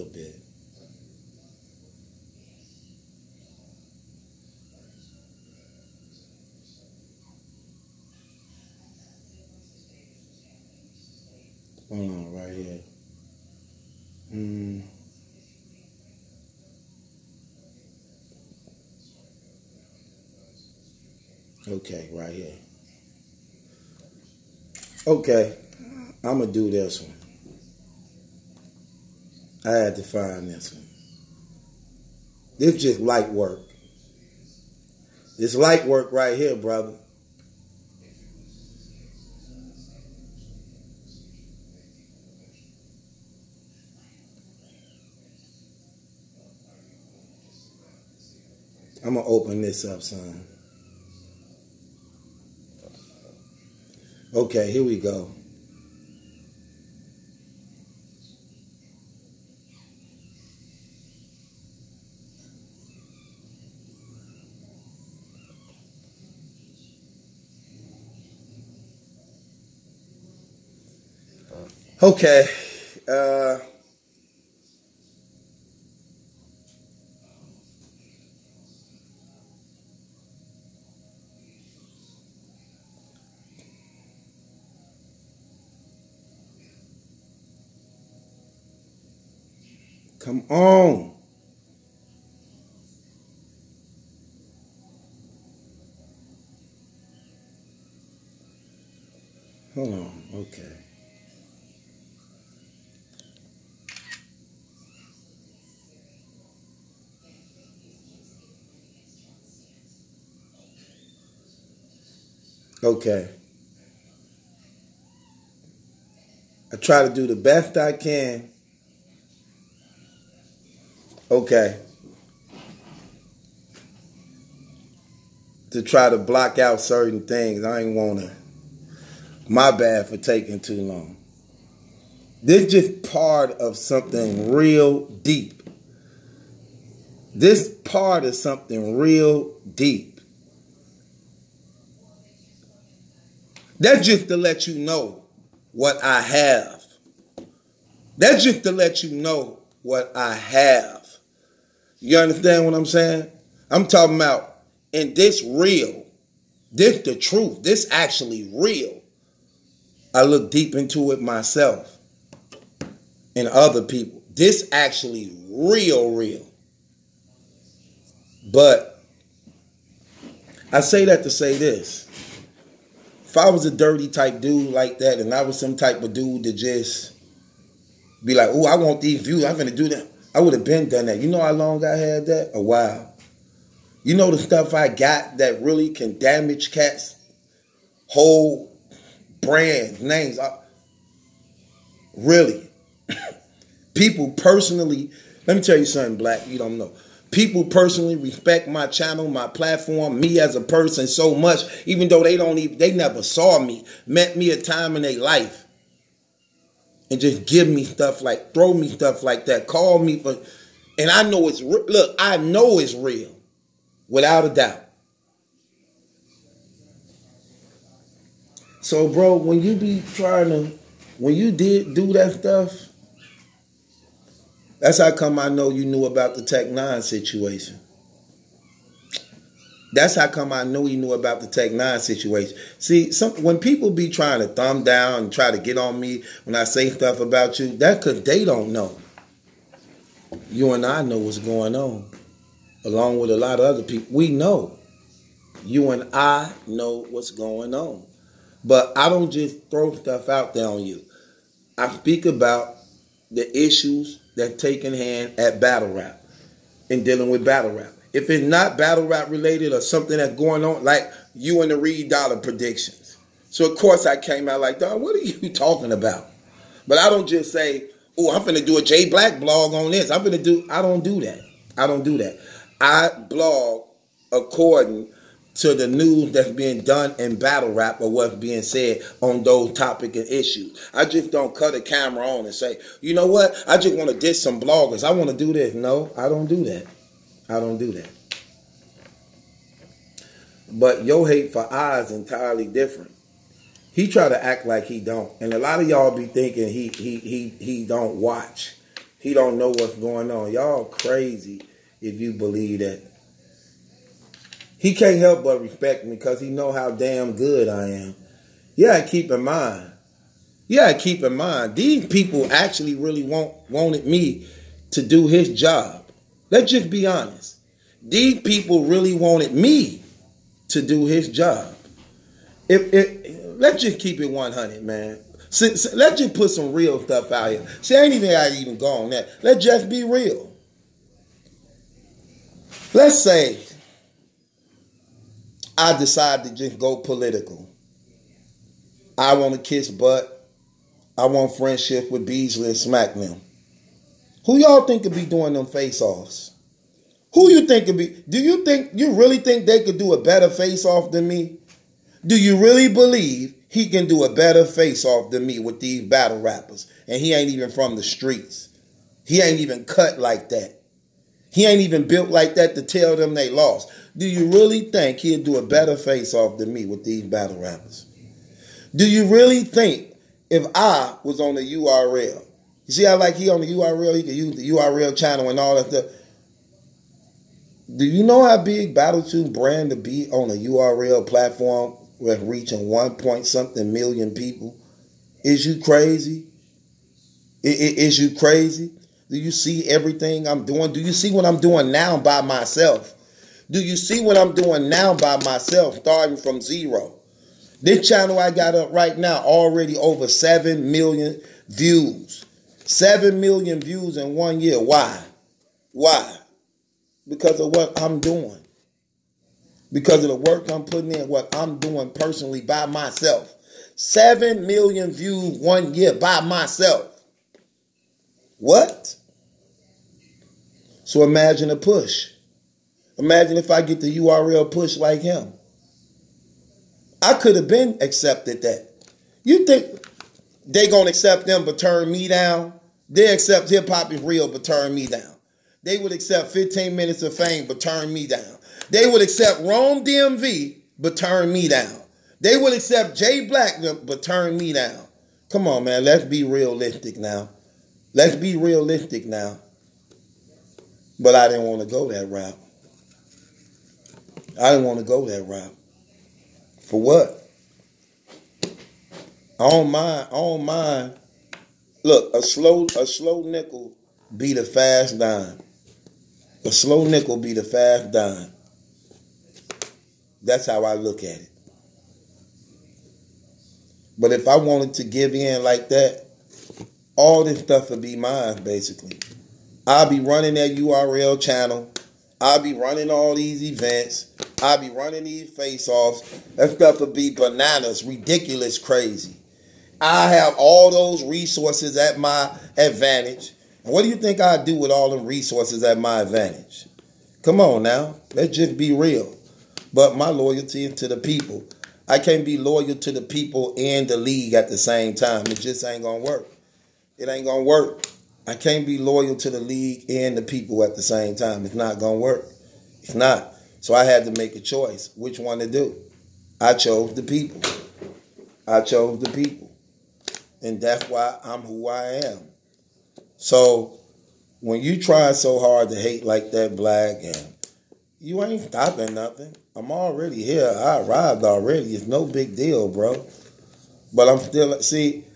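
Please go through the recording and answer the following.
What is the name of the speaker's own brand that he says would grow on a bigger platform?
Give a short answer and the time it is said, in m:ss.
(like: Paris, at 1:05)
Battle Truth, at 6:18.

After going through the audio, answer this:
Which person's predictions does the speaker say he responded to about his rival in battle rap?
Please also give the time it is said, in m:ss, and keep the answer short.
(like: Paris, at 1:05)
Reed Dollaz, at 4:21.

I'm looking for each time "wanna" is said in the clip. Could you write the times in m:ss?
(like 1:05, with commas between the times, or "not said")
2:07.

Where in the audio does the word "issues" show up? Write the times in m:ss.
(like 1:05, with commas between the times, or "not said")
4:13, 4:40.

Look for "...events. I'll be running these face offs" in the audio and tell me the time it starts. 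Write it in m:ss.
8:03.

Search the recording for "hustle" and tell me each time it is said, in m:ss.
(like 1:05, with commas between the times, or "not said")
not said.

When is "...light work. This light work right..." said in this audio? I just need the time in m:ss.
0:32.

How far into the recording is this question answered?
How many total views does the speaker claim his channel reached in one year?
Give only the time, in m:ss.
6:40.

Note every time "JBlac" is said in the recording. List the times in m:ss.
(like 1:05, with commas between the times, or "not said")
4:28, 7:23.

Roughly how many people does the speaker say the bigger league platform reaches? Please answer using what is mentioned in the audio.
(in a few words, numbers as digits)
1 point something million.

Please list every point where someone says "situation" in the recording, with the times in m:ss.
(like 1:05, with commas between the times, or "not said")
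3:47, 3:51.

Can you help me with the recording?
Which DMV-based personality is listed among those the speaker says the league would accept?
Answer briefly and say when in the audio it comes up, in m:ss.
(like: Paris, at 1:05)
Rome DMV, at 7:19.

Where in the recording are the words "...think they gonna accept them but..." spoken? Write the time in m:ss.
7:09.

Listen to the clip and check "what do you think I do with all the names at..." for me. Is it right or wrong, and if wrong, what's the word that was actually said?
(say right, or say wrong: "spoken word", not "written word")
wrong: "resources", not "names".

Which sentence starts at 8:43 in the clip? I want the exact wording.
So when you try so hard to hate like that black and you ain't stopping nothing.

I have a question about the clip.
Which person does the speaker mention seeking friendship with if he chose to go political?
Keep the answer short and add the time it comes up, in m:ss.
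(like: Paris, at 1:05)
Beasley, at 5:42.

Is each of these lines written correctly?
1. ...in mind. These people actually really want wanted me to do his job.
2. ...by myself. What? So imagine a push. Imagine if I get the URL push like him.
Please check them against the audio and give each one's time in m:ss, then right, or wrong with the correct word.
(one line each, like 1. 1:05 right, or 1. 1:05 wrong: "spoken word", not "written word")
1. 5:11 right
2. 6:56 right.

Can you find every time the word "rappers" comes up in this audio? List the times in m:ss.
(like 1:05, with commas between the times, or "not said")
5:56, 6:07.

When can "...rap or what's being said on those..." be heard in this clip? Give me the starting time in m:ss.
4:37.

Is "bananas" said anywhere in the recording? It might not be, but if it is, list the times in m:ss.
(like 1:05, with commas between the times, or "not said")
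8:07.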